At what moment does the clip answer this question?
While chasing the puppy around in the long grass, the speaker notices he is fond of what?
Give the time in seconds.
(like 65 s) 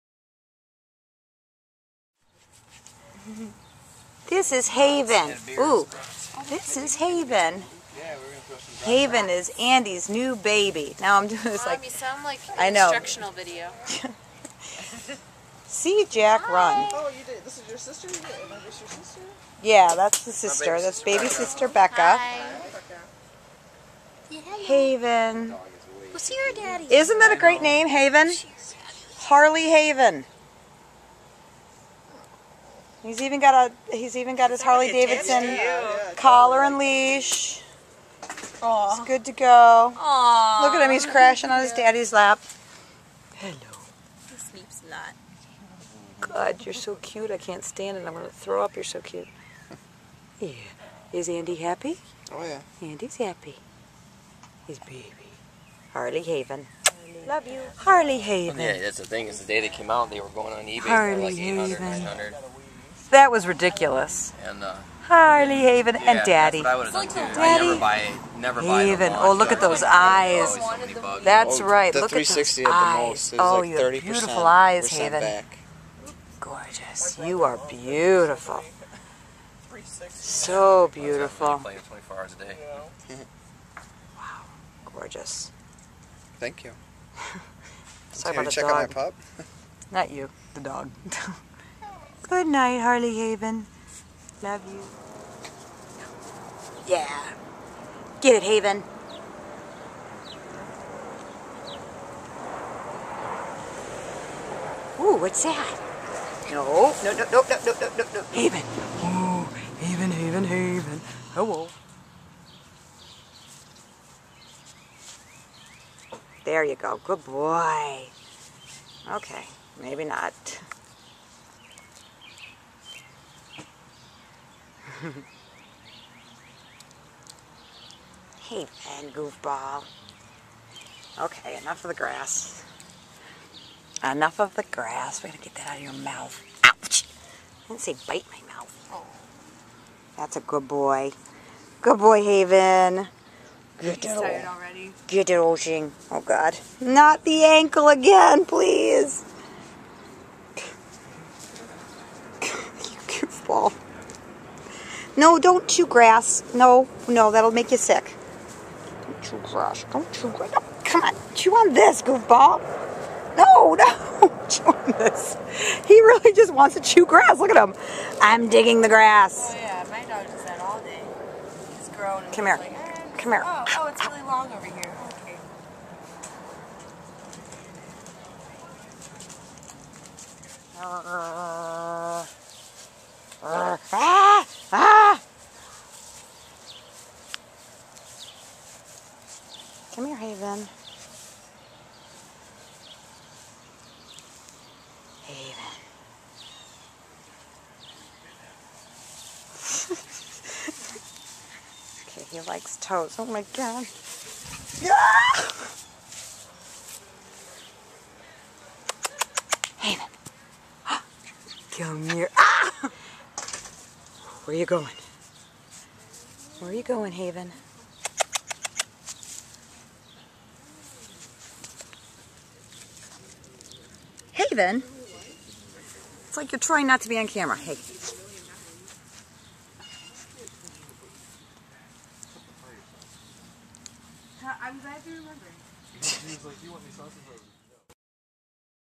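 202 s.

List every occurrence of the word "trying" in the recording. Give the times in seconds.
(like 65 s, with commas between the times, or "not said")
226 s.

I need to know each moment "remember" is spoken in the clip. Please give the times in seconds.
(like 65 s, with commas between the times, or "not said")
236 s.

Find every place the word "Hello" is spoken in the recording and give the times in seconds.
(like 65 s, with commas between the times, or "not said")
43 s, 111 s.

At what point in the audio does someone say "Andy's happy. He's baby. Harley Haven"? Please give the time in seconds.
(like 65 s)
52 s.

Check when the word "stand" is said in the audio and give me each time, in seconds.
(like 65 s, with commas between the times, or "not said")
47 s.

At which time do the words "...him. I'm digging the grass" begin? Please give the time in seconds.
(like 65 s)
167 s.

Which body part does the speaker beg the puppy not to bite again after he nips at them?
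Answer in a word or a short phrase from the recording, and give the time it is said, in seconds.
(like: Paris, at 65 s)
Ankle, at 147 s.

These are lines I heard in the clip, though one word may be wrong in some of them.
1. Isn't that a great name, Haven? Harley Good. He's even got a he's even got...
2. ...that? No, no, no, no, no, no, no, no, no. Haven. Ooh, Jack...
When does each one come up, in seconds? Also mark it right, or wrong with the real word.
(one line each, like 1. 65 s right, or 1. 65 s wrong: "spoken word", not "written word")
1. 26 s wrong: "Haven", not "Good"
2. 105 s wrong: "Haven", not "Jack".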